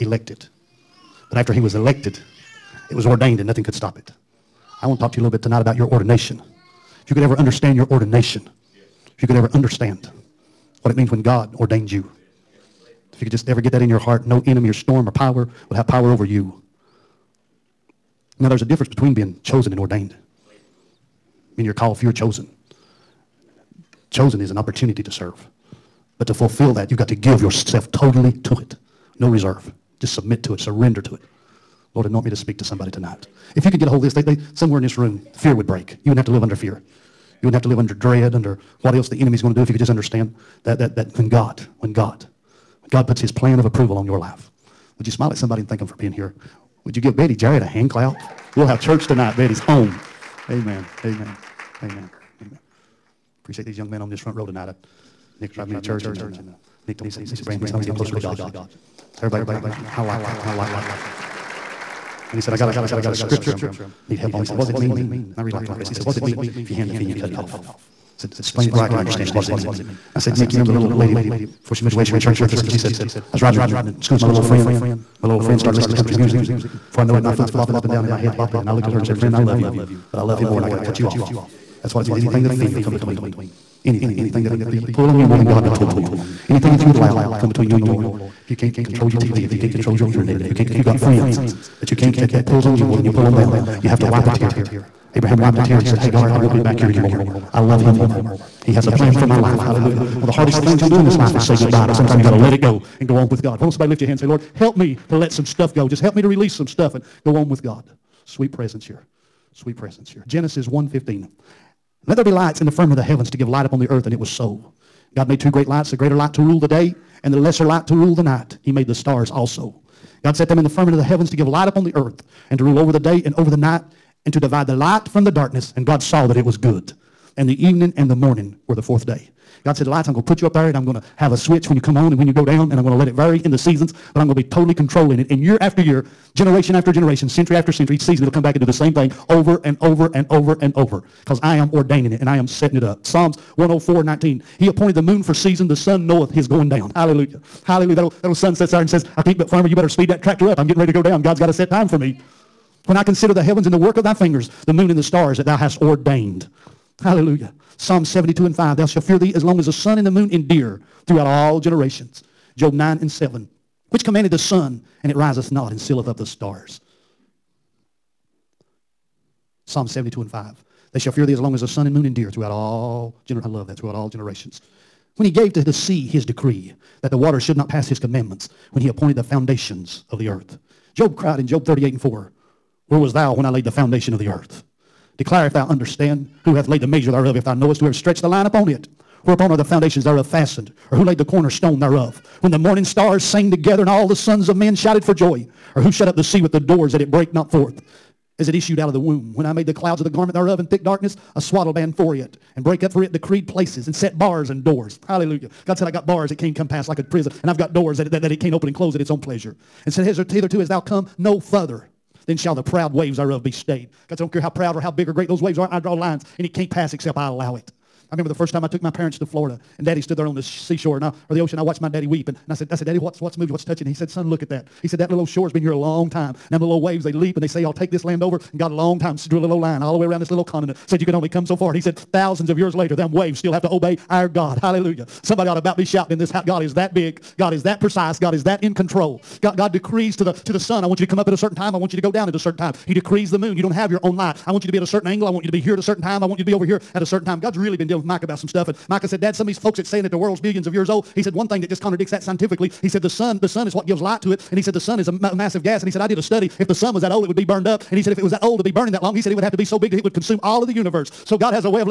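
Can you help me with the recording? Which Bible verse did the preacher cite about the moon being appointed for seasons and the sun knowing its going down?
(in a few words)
Psalms 104:19.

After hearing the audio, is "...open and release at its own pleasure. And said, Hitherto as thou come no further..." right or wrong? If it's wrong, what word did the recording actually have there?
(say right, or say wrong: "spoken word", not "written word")
wrong: "close", not "release".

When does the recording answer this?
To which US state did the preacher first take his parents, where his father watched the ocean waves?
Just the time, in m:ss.
3:39.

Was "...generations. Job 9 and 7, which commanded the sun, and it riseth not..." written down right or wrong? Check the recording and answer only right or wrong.
right.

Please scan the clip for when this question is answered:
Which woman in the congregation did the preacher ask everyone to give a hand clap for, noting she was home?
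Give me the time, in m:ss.
0:47.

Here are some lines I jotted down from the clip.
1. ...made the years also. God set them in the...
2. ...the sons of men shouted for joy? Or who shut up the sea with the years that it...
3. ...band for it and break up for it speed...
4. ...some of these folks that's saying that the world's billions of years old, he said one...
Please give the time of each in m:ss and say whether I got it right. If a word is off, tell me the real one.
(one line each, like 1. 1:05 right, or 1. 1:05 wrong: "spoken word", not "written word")
1. 1:58 wrong: "stars", not "years"
2. 3:14 wrong: "doors", not "years"
3. 3:21 wrong: "decreed", not "speed"
4. 4:09 right.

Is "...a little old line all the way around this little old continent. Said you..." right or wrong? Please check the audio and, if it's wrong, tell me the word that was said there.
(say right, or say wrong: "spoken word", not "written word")
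right.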